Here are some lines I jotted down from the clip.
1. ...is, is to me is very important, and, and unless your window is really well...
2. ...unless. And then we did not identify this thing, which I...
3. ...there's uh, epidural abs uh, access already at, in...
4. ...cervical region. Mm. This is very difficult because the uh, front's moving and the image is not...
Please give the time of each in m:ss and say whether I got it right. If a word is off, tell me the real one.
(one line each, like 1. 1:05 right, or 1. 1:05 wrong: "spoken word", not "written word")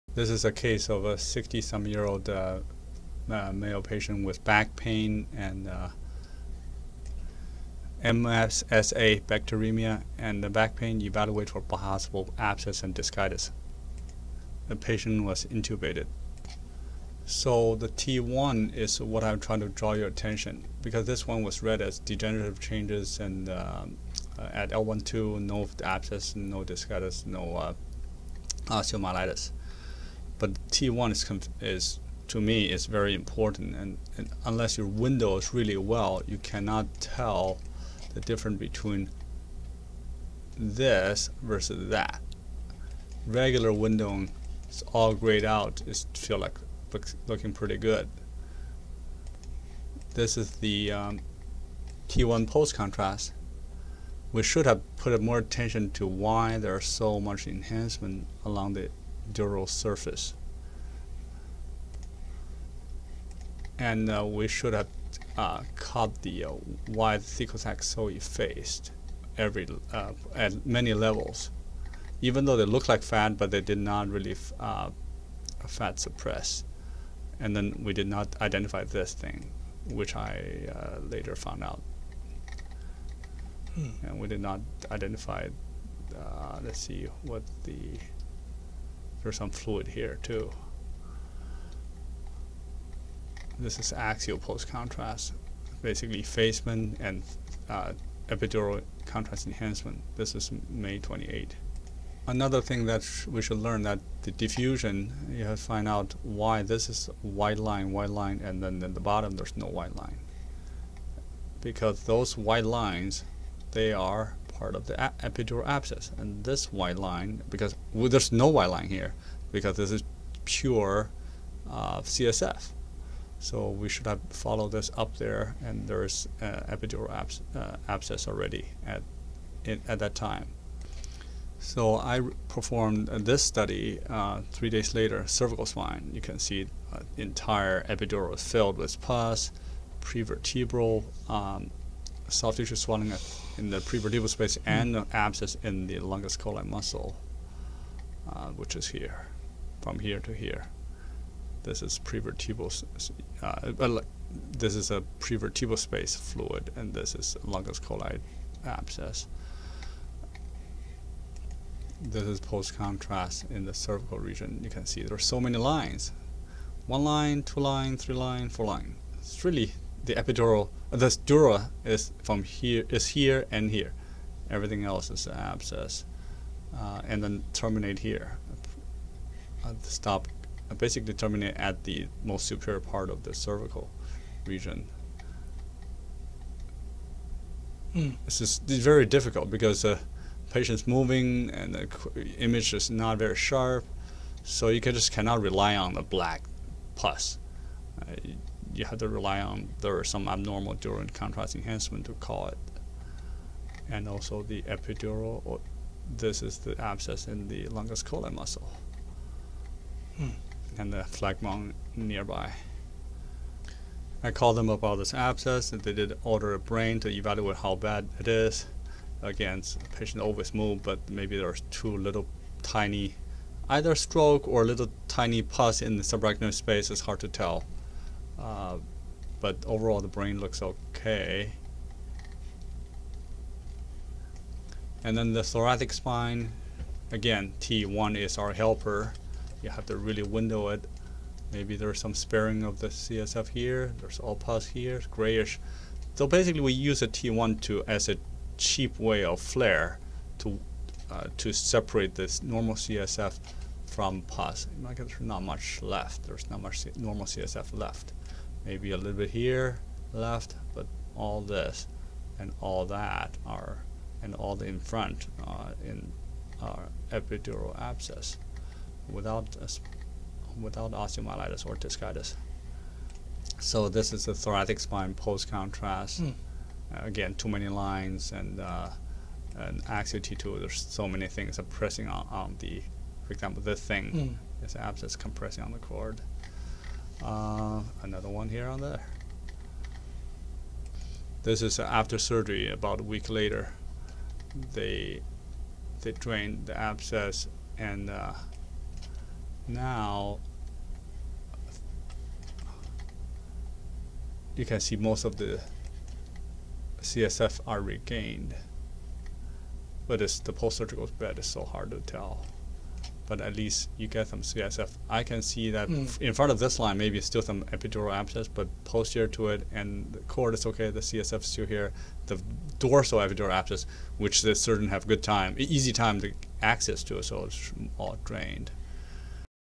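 1. 0:31 right
2. 1:15 wrong: "suppress", not "unless"
3. 2:05 wrong: "abscess", not "access"
4. 3:03 wrong: "patient", not "front".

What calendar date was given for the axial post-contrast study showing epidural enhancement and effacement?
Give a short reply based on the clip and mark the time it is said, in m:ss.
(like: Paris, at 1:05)
May 28, at 1:40.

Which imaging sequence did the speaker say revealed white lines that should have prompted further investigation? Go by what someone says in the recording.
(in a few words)
diffusion.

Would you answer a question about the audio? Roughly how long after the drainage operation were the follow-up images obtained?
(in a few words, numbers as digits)
about a week later.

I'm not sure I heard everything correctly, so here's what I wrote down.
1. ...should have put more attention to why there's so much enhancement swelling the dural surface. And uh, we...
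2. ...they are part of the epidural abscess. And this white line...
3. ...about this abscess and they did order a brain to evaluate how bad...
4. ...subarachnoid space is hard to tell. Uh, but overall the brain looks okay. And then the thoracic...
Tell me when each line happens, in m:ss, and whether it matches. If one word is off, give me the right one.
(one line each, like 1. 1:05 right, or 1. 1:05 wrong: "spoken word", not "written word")
1. 0:54 wrong: "along", not "swelling"
2. 1:53 right
3. 3:34 right
4. 3:46 right.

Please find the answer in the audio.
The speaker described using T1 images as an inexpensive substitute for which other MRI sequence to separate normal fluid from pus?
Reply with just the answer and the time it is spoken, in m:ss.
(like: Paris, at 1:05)
FLAIR, at 4:09.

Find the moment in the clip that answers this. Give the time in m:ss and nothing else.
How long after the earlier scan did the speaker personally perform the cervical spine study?
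2:14.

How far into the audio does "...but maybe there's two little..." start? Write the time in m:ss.
3:40.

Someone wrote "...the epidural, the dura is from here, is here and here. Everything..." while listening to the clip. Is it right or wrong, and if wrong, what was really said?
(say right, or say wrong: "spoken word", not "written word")
right.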